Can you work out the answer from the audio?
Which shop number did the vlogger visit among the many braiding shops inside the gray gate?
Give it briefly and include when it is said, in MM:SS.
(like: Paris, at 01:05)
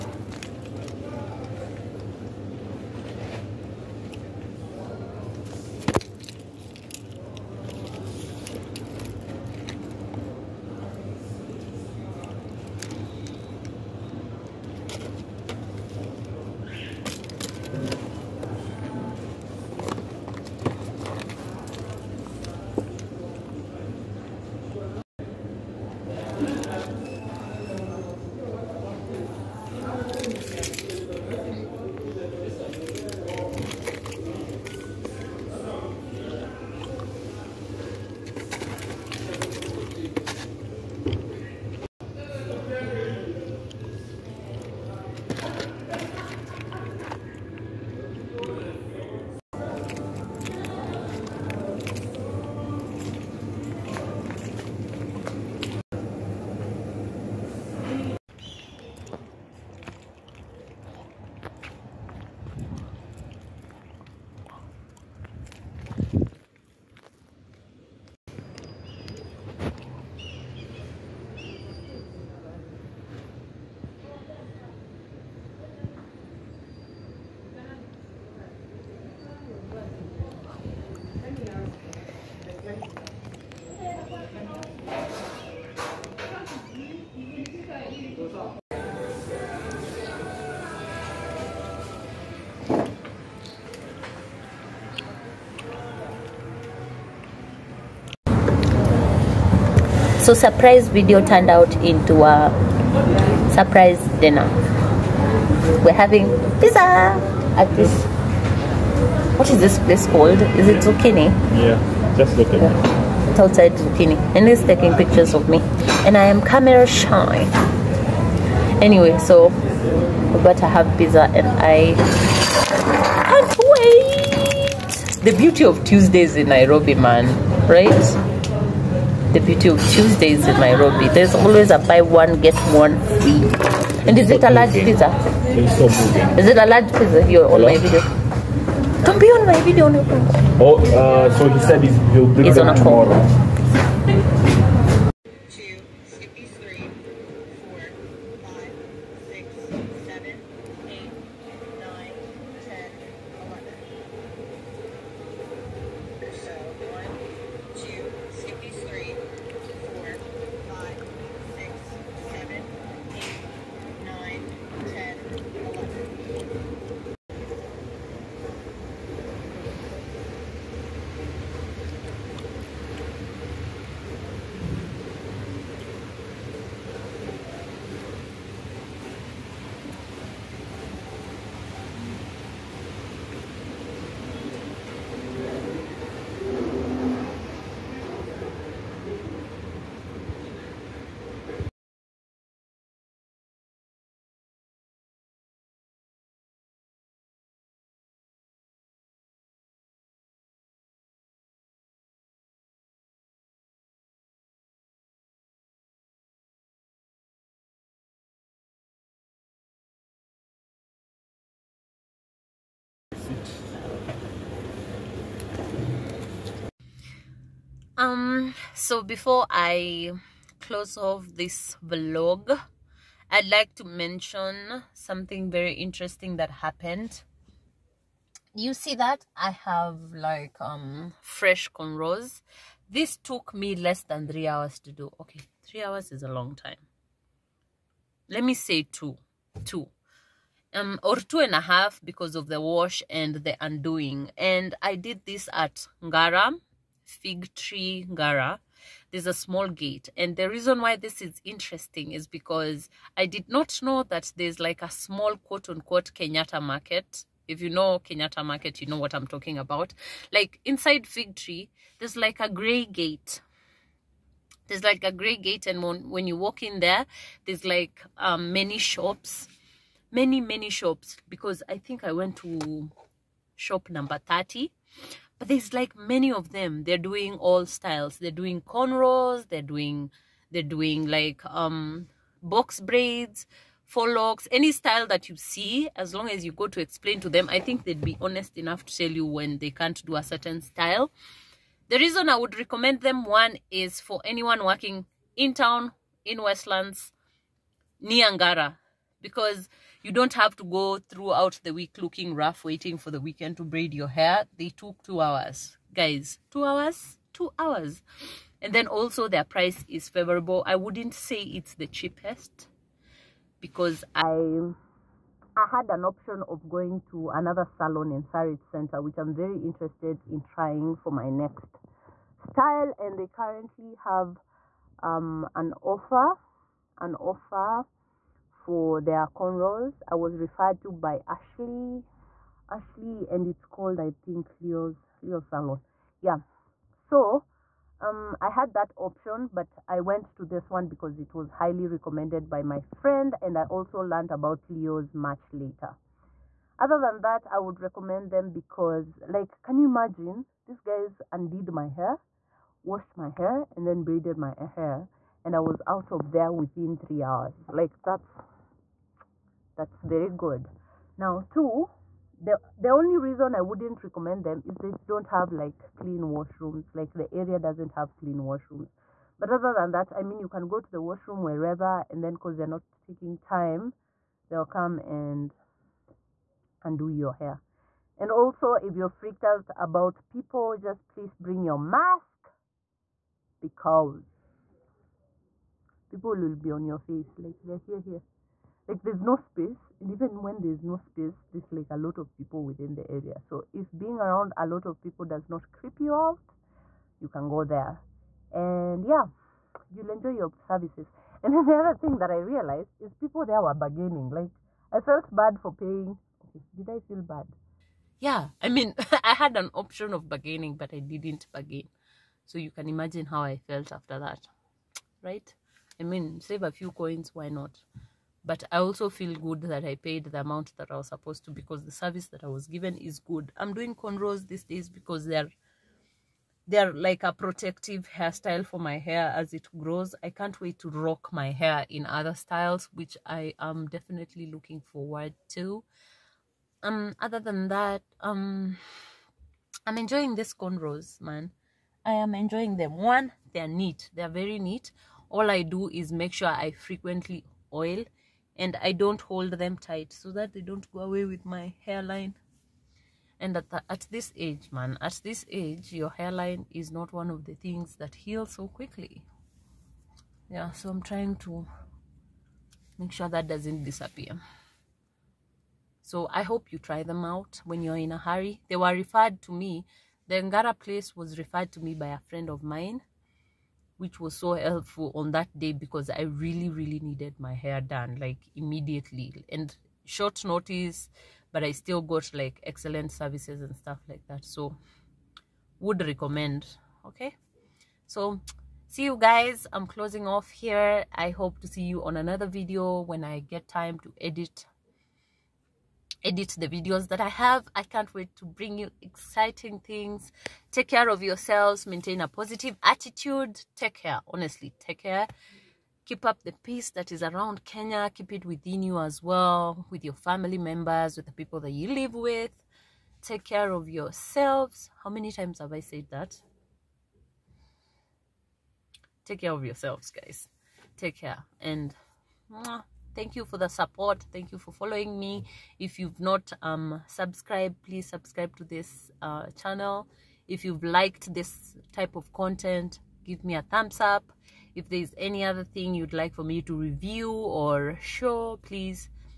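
30, at 04:33.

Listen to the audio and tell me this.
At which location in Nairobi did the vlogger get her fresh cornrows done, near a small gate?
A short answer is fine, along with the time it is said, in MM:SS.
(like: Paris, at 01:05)
Ngara Fig Tree, at 04:06.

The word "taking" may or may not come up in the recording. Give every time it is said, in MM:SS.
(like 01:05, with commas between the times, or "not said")
01:54, 06:12.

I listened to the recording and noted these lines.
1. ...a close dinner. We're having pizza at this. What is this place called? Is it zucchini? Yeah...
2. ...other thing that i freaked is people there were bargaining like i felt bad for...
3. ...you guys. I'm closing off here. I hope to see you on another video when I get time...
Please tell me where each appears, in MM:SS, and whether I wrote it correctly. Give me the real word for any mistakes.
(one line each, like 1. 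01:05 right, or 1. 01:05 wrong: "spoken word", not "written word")
1. 01:42 wrong: "surprise", not "close"
2. 06:41 wrong: "realized", not "freaked"
3. 08:09 right.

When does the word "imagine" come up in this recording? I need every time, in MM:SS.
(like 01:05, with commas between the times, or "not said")
05:49, 06:52.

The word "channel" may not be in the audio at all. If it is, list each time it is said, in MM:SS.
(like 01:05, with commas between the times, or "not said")
08:49.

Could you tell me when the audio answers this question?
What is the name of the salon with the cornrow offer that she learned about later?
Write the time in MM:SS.
05:35.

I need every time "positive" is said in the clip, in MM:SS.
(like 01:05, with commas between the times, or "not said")
08:22.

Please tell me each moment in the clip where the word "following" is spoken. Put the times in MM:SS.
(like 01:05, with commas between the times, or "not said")
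08:44.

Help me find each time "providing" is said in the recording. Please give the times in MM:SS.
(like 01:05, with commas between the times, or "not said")
not said.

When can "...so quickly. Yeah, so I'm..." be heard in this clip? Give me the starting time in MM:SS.
07:38.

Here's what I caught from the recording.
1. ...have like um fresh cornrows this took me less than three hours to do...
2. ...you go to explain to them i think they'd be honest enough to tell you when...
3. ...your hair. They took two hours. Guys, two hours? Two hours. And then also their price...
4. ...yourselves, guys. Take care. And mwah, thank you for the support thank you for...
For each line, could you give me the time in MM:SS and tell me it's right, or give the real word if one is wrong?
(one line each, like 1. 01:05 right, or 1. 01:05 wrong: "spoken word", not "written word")
1. 03:49 right
2. 04:46 right
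3. 05:03 right
4. 08:39 right.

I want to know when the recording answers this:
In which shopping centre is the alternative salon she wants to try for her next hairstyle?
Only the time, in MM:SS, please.
05:18.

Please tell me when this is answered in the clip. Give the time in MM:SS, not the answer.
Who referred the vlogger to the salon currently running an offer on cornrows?
05:30.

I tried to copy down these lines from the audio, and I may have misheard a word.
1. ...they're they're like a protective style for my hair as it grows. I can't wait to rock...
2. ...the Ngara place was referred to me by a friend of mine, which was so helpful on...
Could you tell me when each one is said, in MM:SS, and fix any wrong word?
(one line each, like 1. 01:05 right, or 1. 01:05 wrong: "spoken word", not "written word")
1. 07:05 wrong: "hairstyle", not "style"
2. 07:50 right.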